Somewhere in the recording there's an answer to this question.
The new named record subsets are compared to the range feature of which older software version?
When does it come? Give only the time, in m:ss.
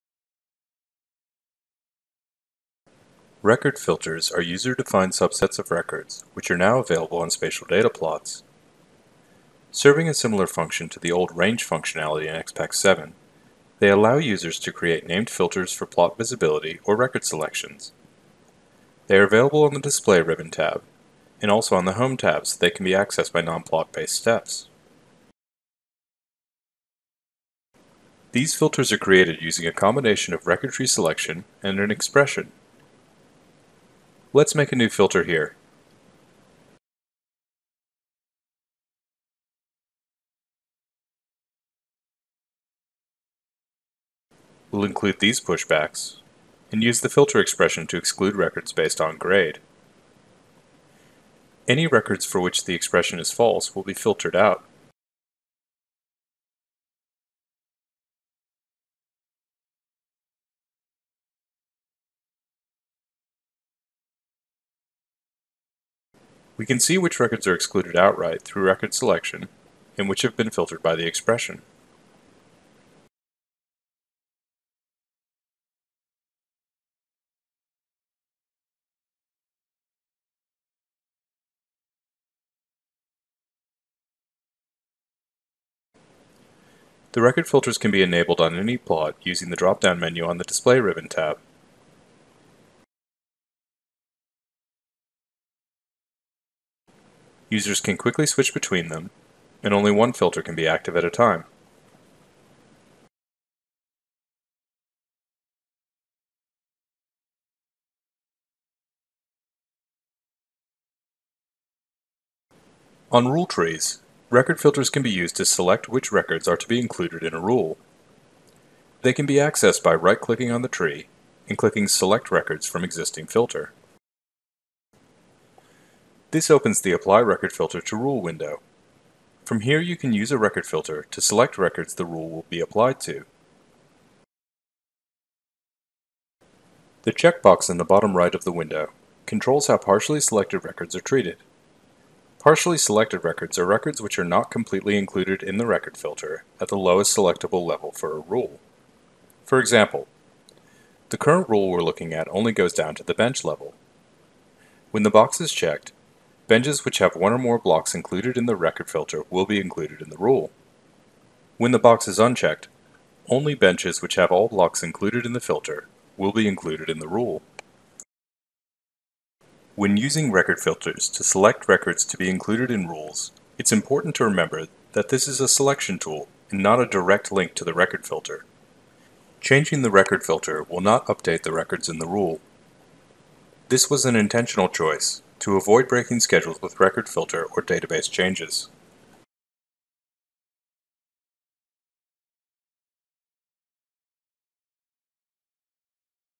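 0:12.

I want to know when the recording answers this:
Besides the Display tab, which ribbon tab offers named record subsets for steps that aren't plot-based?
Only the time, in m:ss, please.
0:21.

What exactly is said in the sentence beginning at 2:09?
From here you can use a record filter to select records the rule will be applied to.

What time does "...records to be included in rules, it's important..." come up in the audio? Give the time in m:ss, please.
2:51.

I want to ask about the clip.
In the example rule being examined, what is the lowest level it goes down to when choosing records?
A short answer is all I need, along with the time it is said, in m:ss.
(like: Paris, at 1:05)
Bench level, at 2:33.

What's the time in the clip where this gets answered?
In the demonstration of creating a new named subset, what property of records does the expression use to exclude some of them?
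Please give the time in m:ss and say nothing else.
0:49.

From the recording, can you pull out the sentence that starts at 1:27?
The record filters can be enabled on any plot using the drop-down menu on the Display ribbon tab.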